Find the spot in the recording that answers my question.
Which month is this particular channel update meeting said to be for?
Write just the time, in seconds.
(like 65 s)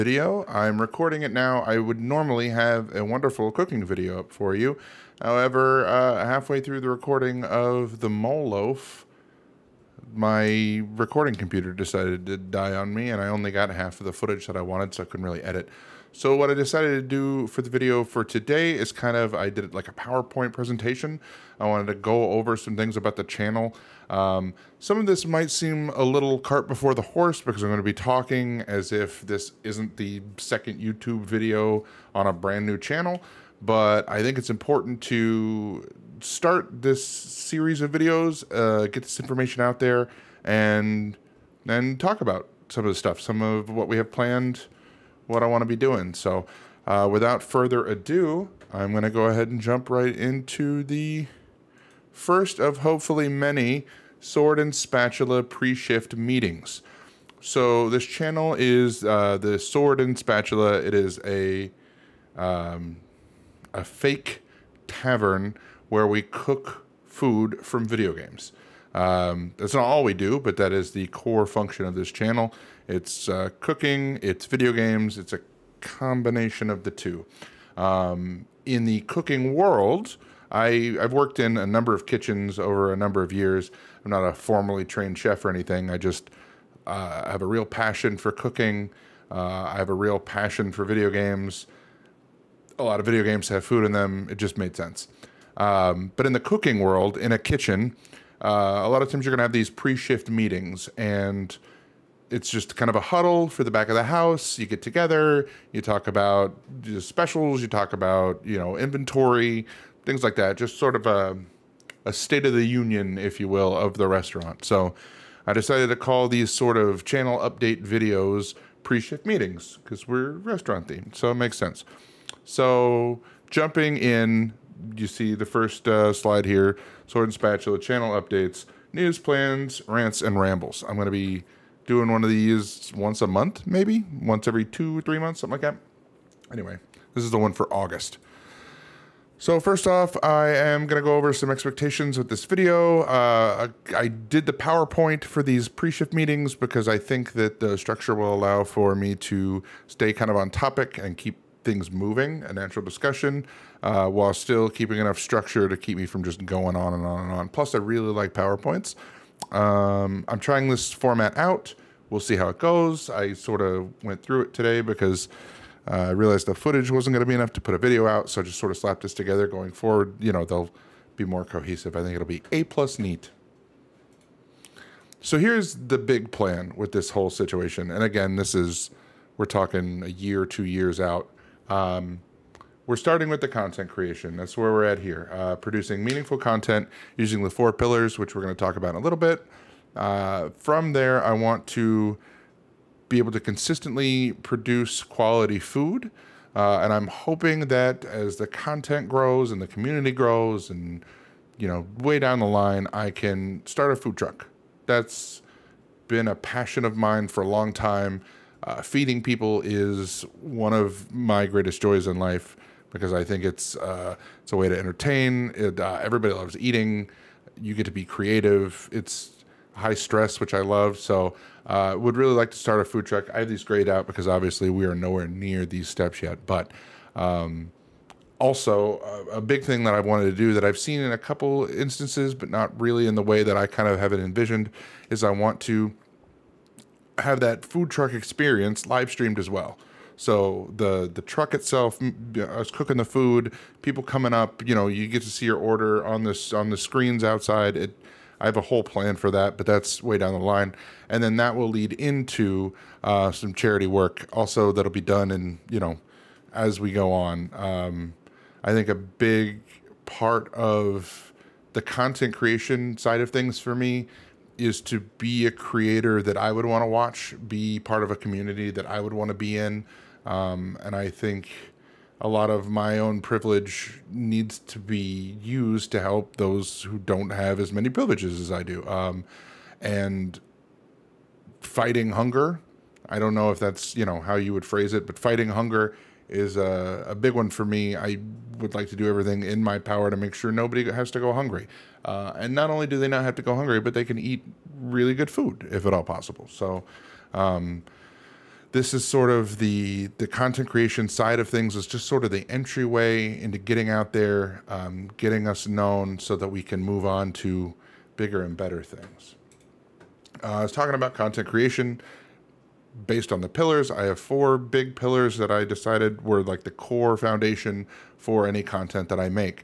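137 s.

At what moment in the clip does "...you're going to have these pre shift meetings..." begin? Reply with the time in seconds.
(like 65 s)
99 s.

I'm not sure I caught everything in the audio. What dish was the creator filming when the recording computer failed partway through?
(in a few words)
mole loaf.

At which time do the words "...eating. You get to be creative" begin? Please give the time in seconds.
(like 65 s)
216 s.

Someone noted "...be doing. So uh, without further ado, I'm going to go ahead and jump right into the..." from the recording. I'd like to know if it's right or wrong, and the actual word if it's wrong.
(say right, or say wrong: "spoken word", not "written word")
right.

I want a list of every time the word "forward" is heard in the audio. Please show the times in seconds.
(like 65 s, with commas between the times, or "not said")
169 s.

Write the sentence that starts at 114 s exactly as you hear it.
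So I decided to call these sort of channel update videos pre-shift meetings because we're restaurant themed, so it makes sense.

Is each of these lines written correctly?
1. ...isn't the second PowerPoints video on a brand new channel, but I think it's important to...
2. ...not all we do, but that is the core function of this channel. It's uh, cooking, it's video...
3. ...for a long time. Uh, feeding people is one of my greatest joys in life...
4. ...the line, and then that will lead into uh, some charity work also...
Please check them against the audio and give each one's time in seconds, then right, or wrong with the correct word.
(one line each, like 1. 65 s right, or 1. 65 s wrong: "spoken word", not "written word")
1. 29 s wrong: "YouTube", not "PowerPoints"
2. 69 s right
3. 207 s right
4. 250 s right.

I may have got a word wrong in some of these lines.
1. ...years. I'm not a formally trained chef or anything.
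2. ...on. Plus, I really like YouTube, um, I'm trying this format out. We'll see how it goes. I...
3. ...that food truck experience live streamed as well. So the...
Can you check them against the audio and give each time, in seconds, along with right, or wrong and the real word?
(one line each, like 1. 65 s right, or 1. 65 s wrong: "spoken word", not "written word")
1. 83 s right
2. 157 s wrong: "PowerPoints", not "YouTube"
3. 237 s right.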